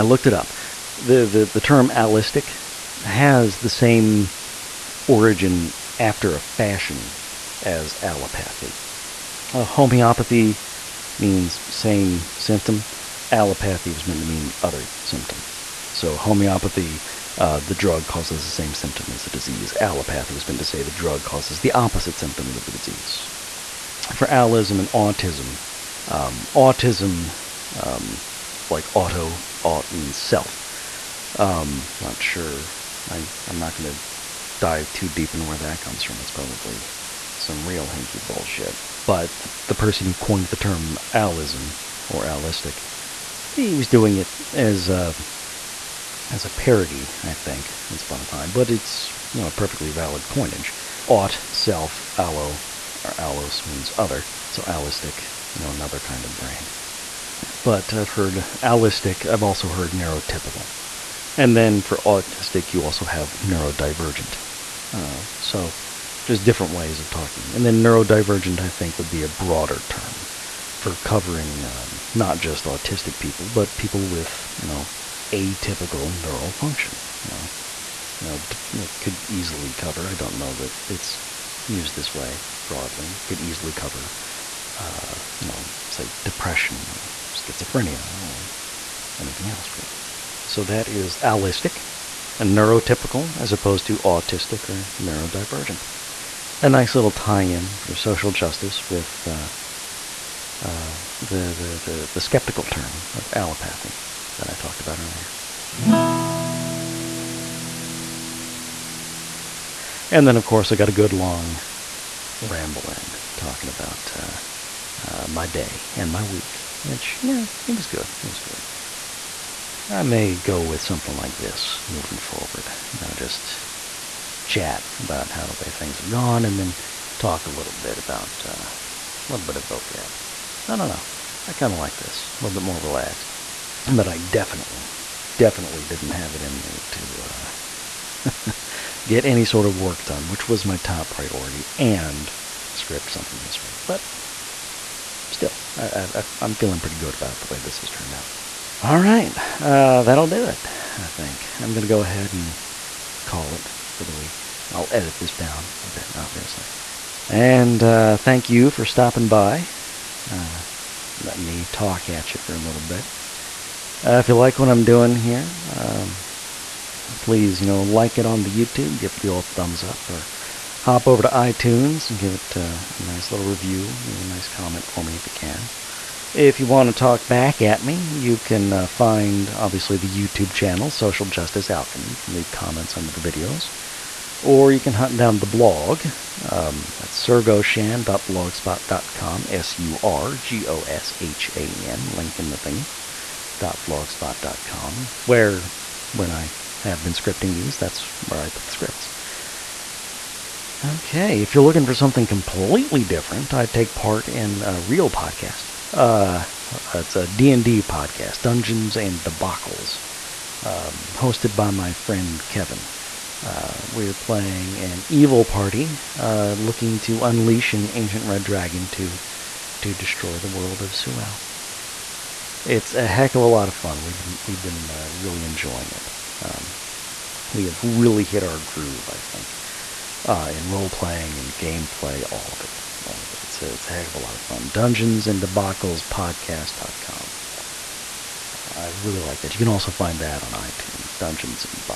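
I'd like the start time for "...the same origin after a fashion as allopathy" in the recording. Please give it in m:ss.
0:03.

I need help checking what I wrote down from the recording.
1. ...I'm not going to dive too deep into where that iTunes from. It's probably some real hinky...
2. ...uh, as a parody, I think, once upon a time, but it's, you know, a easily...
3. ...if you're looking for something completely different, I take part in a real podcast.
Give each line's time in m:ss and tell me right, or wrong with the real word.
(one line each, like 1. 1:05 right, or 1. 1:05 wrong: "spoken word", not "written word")
1. 0:33 wrong: "comes", not "iTunes"
2. 0:44 wrong: "perfectly", not "easily"
3. 3:21 right.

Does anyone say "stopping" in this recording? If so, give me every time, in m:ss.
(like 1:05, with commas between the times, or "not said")
2:38.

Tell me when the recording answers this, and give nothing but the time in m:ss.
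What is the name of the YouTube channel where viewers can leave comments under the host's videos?
3:00.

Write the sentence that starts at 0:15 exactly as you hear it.
So homeopathy, uh, the drug causes the same symptom as the disease.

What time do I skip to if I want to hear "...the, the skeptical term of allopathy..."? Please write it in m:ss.
1:41.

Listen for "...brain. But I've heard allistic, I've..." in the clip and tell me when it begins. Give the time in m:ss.
0:56.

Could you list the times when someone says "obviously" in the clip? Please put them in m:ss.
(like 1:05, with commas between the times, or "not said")
2:36, 2:59.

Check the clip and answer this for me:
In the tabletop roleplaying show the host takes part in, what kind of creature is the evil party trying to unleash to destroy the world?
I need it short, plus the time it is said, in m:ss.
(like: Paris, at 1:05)
ancient red dragon, at 3:37.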